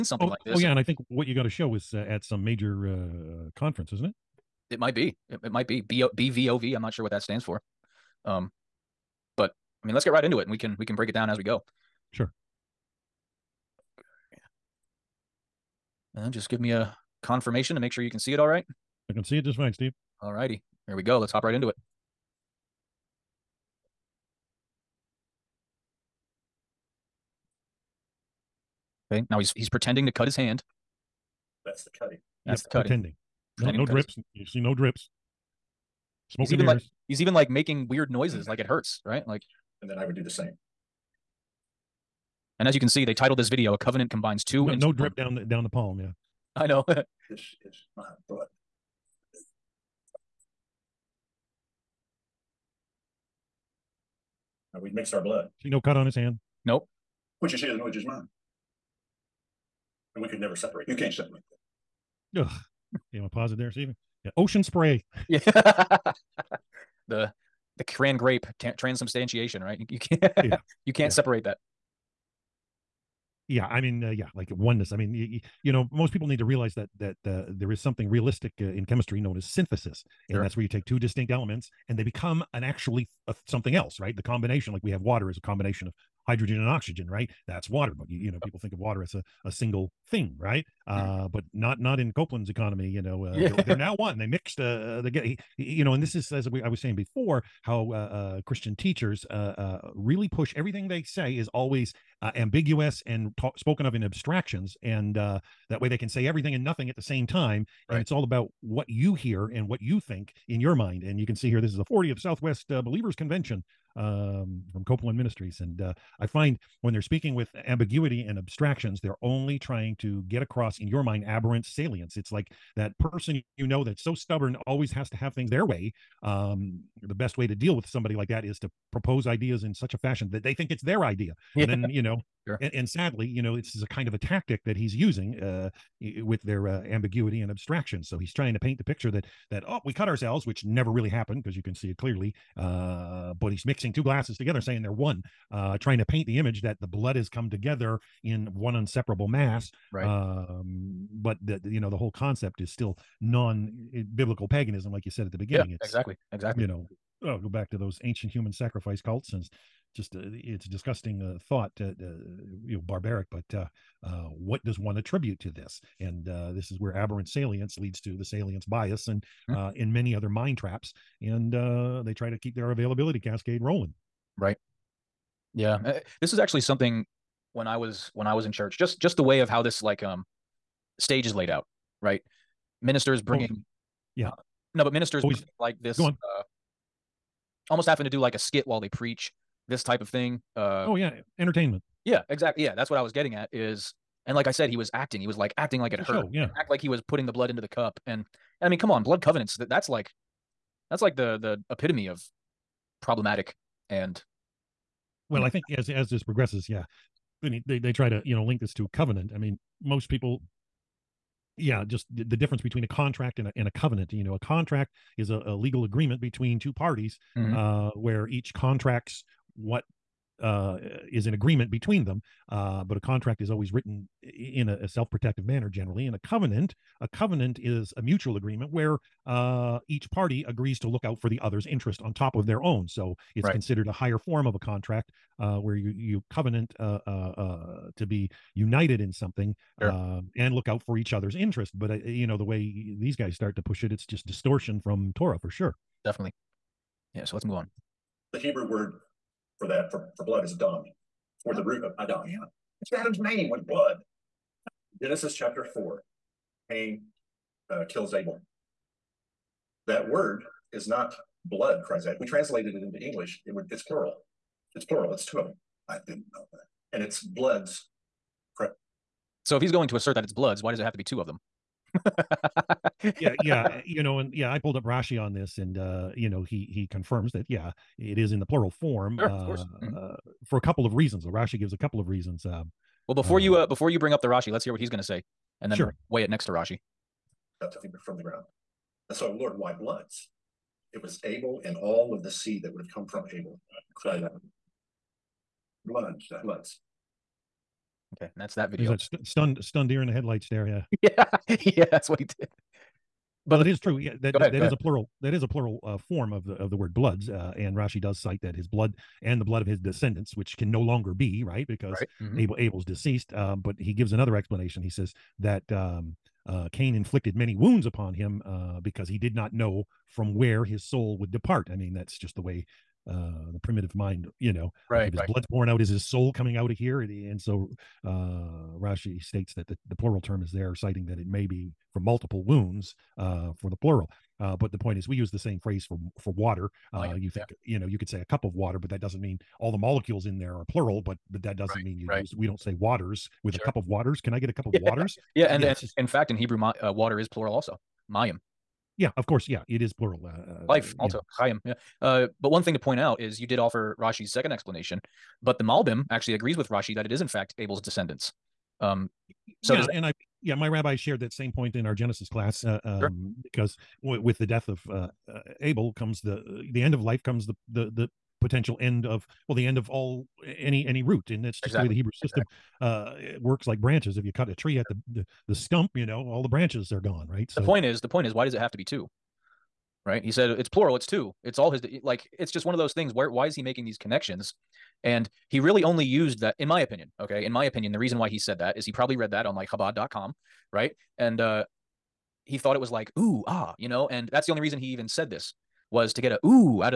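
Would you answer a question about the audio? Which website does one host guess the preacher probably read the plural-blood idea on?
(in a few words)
chabad.com.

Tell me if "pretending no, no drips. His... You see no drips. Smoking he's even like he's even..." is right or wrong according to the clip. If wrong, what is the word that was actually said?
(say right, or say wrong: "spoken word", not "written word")
right.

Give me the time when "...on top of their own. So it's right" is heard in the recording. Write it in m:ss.
3:52.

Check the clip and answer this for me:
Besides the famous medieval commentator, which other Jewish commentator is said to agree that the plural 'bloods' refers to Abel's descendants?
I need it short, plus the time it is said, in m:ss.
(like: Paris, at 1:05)
the Malbim, at 5:55.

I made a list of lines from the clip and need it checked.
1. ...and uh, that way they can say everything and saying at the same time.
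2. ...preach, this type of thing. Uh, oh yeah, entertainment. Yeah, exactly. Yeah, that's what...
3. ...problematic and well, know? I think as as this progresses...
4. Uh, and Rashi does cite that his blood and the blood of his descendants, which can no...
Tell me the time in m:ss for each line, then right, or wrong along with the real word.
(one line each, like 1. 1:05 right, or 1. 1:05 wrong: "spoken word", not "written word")
1. 1:44 wrong: "nothing", not "saying"
2. 3:08 right
3. 3:23 right
4. 5:07 right.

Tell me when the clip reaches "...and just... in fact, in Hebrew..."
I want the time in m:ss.
5:45.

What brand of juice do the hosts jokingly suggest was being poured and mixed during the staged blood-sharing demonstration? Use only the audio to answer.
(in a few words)
Ocean Spray.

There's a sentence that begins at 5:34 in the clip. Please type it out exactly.
Uh, but the point is, we use the same phrase for for water.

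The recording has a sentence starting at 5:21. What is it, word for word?
I mean, that's just the way uh, the primitive mind, you know, right?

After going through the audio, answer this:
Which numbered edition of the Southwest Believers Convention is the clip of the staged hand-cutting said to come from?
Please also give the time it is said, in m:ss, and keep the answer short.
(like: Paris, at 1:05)
40th, at 1:51.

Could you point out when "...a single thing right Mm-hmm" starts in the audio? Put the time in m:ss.
1:29.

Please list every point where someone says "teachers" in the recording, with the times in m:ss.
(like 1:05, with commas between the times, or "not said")
1:38.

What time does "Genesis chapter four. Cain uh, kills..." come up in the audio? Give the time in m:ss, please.
4:15.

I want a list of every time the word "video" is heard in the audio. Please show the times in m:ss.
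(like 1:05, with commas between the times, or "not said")
0:43, 4:58.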